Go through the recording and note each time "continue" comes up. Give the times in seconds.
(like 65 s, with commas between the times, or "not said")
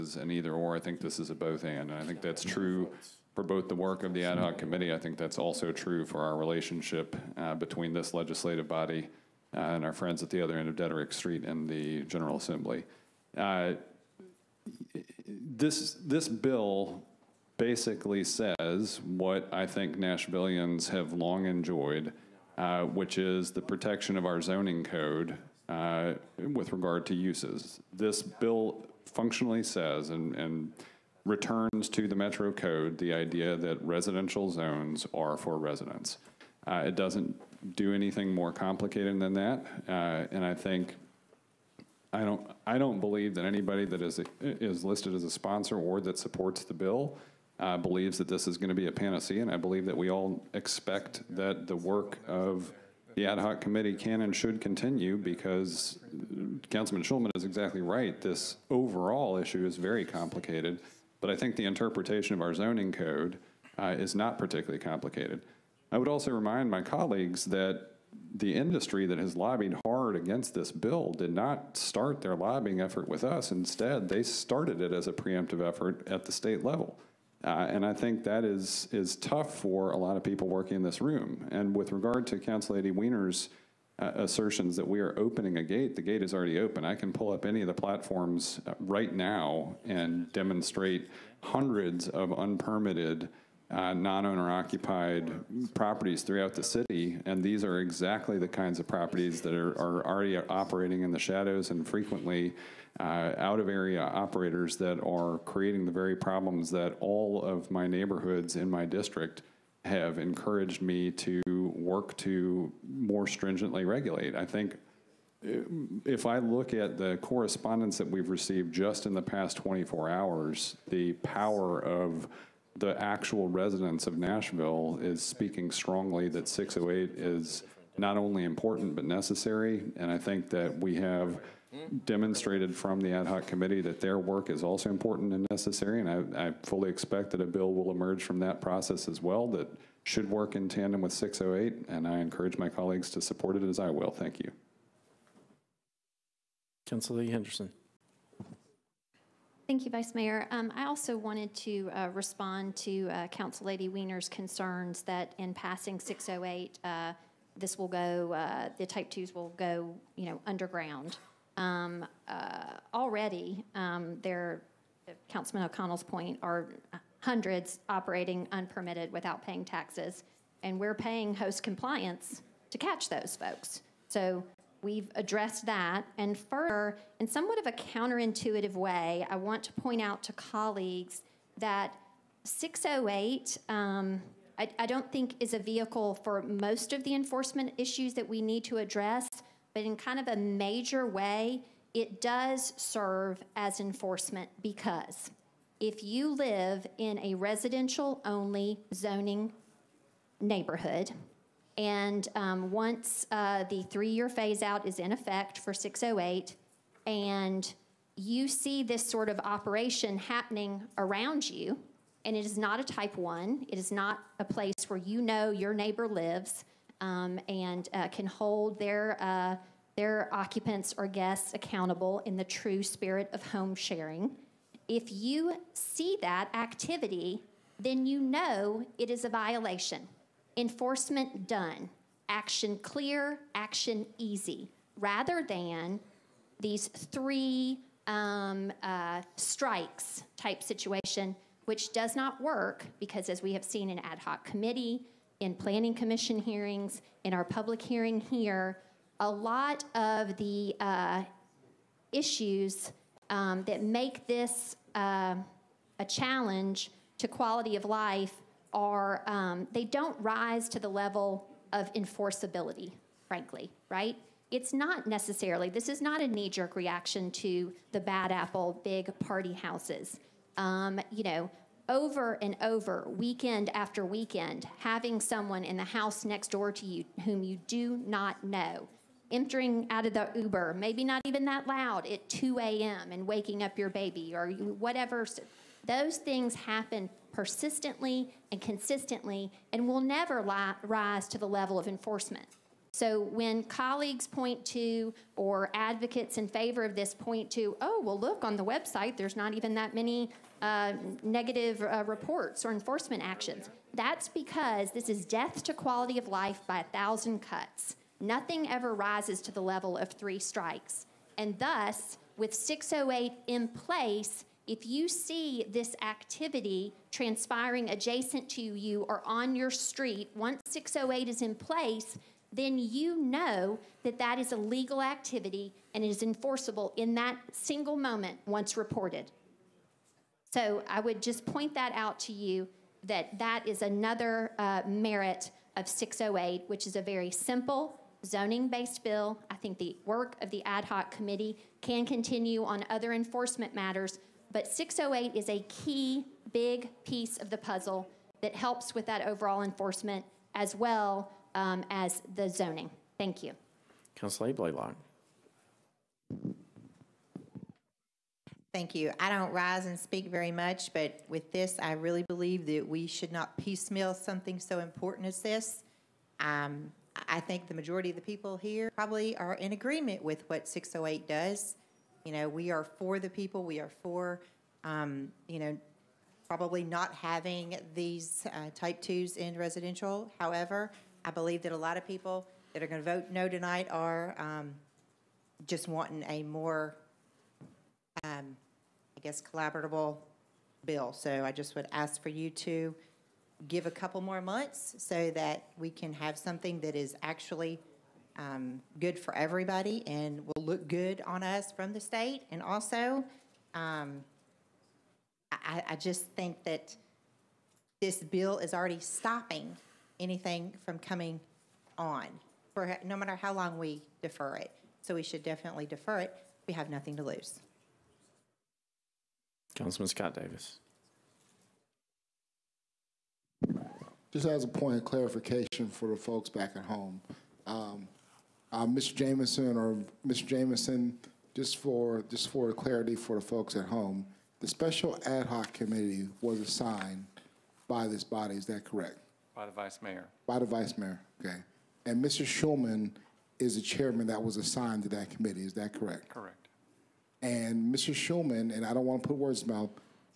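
54 s, 342 s.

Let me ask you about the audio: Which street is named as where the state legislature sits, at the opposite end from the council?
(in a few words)
Deaderick Street.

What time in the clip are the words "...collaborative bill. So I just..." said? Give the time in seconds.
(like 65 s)
389 s.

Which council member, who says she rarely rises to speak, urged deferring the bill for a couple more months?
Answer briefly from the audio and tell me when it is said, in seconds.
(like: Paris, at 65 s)
Blalock, at 354 s.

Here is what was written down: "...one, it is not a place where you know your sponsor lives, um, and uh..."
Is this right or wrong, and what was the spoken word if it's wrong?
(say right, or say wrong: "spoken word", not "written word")
wrong: "neighbor", not "sponsor".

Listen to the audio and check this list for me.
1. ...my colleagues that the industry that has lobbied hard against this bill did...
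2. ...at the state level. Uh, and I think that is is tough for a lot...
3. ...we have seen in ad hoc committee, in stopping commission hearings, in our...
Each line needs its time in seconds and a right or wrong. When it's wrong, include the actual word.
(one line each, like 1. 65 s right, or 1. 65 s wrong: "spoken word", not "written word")
1. 66 s right
2. 76 s right
3. 243 s wrong: "planning", not "stopping".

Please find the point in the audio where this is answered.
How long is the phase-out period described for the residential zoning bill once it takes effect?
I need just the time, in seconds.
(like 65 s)
203 s.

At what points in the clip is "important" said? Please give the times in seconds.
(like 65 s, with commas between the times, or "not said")
128 s, 134 s, 364 s.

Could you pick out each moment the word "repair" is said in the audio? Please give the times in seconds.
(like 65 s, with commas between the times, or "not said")
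not said.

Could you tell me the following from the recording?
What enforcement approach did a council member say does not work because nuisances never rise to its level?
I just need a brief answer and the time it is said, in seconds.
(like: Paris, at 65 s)
three strikes, at 236 s.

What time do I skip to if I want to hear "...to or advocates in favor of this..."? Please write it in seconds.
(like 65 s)
294 s.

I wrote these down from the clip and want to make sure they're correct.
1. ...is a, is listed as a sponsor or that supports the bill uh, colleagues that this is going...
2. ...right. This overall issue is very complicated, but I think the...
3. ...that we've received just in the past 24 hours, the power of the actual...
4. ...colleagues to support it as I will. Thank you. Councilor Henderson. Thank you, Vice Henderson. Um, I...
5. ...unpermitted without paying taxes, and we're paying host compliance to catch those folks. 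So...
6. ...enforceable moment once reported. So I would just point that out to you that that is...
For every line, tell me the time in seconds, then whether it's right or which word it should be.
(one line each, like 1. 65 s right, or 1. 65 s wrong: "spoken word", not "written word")
1. 44 s wrong: "believes", not "colleagues"
2. 57 s right
3. 117 s right
4. 142 s wrong: "Mayor", not "Henderson"
5. 168 s right
6. 327 s wrong: "single", not "enforceable".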